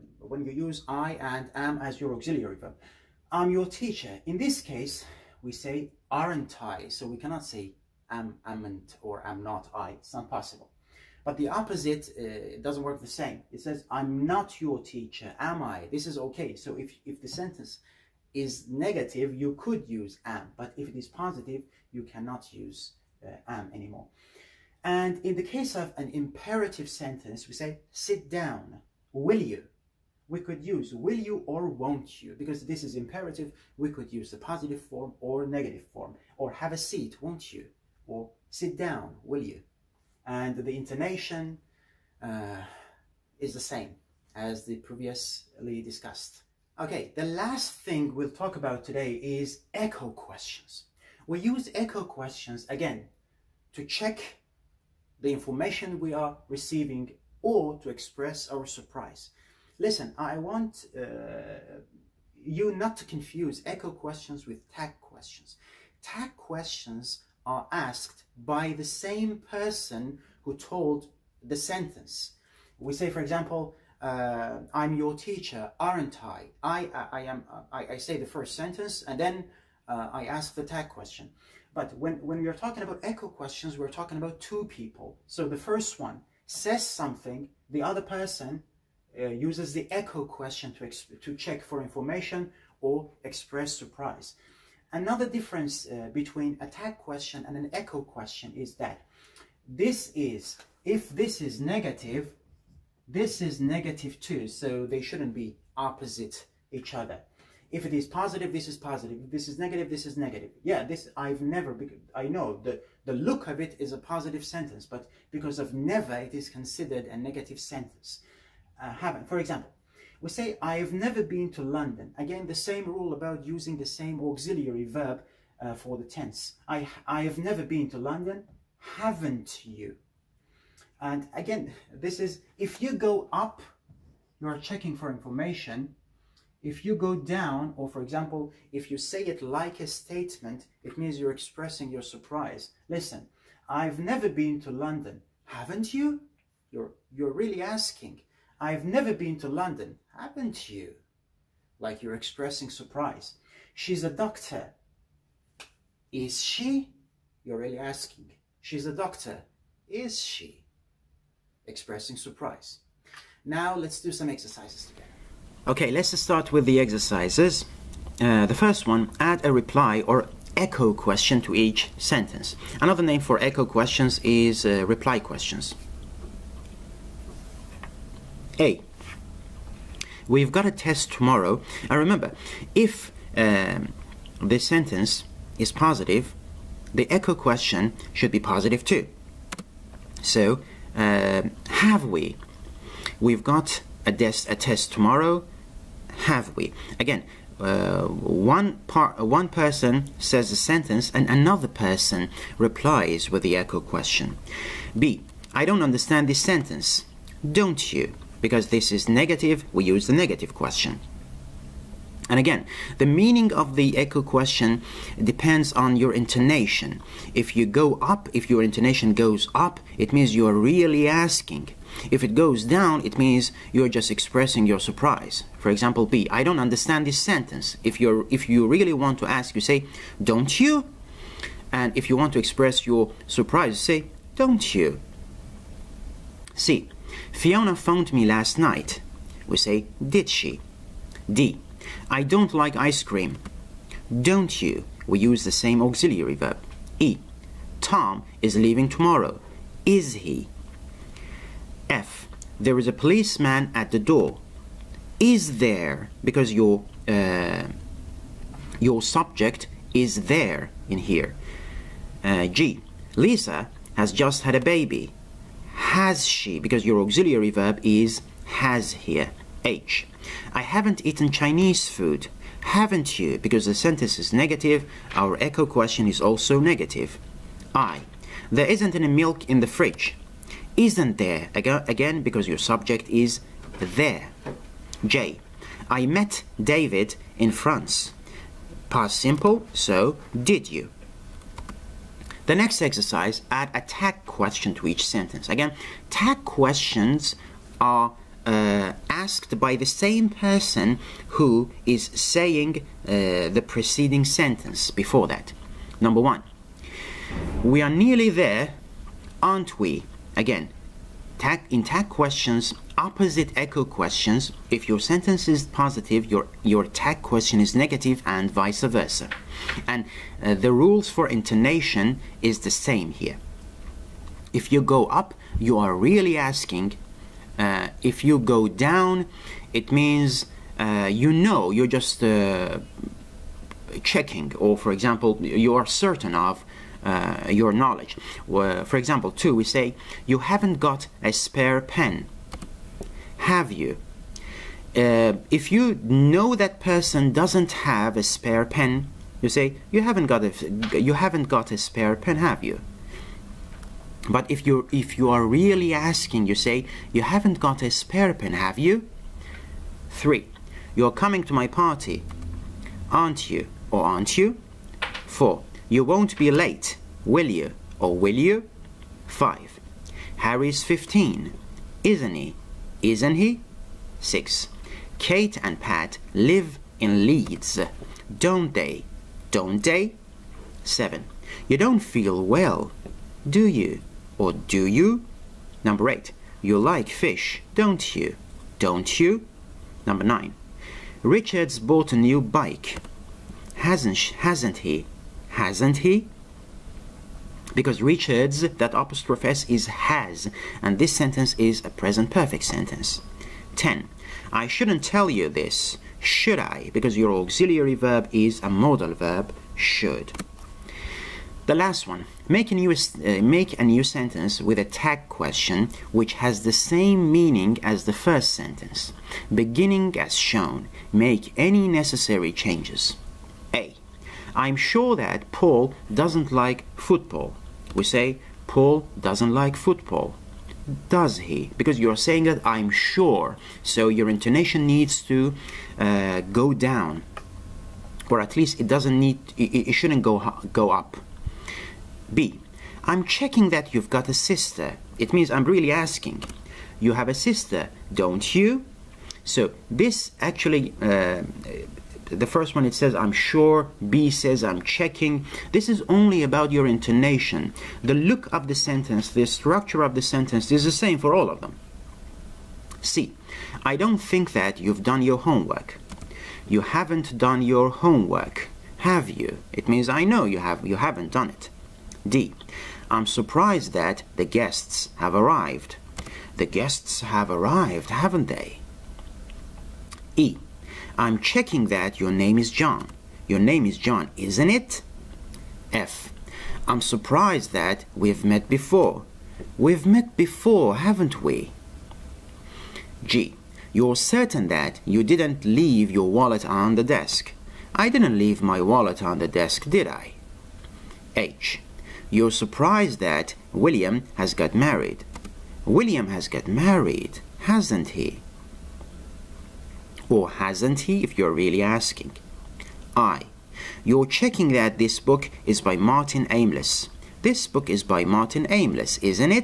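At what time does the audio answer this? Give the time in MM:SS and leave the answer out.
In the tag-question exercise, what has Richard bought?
06:32.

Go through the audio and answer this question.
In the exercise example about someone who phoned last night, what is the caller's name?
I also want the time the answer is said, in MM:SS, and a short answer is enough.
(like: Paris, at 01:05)
Fiona, at 03:57.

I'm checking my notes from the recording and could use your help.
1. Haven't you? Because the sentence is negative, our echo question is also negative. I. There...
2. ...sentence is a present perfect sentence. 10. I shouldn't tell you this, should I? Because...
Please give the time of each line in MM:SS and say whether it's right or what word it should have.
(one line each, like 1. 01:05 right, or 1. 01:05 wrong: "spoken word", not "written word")
1. 04:32 right
2. 06:41 right.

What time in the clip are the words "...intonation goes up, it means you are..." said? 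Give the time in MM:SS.
03:38.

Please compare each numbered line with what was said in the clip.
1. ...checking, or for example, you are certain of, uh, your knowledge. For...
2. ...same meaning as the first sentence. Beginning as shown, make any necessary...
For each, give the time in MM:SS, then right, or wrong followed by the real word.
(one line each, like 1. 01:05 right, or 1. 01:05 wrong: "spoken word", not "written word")
1. 05:34 right
2. 06:56 right.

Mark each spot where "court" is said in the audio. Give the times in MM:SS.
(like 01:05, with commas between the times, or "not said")
not said.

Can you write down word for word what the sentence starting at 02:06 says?
I, I have never been to London.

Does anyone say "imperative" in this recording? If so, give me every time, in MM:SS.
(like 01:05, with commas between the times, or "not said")
00:26, 00:32.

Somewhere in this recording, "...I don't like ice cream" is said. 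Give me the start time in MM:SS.
04:02.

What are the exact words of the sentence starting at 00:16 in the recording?
So if, if the sentence is negative, you could use am.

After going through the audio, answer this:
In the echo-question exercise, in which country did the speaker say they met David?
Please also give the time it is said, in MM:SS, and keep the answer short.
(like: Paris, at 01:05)
France, at 04:47.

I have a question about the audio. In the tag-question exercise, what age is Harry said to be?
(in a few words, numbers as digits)
15.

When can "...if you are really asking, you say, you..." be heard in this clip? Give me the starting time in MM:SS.
05:54.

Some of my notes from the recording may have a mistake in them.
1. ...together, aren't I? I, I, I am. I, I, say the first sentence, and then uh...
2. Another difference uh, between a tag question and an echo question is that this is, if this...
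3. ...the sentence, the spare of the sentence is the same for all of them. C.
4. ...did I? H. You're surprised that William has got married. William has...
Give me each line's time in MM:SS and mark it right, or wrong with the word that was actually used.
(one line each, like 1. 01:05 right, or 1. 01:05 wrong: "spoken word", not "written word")
1. 01:15 wrong: "teacher", not "together"
2. 01:34 right
3. 07:38 wrong: "structure", not "spare"
4. 08:19 right.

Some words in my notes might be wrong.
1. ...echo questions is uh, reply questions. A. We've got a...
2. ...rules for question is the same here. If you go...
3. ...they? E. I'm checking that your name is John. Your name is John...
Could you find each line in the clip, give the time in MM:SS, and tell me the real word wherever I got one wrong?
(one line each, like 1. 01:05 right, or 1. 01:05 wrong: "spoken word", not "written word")
1. 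02:53 right
2. 05:20 wrong: "intonation", not "question"
3. 07:58 right.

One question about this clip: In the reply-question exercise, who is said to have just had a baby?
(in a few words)
Lisa.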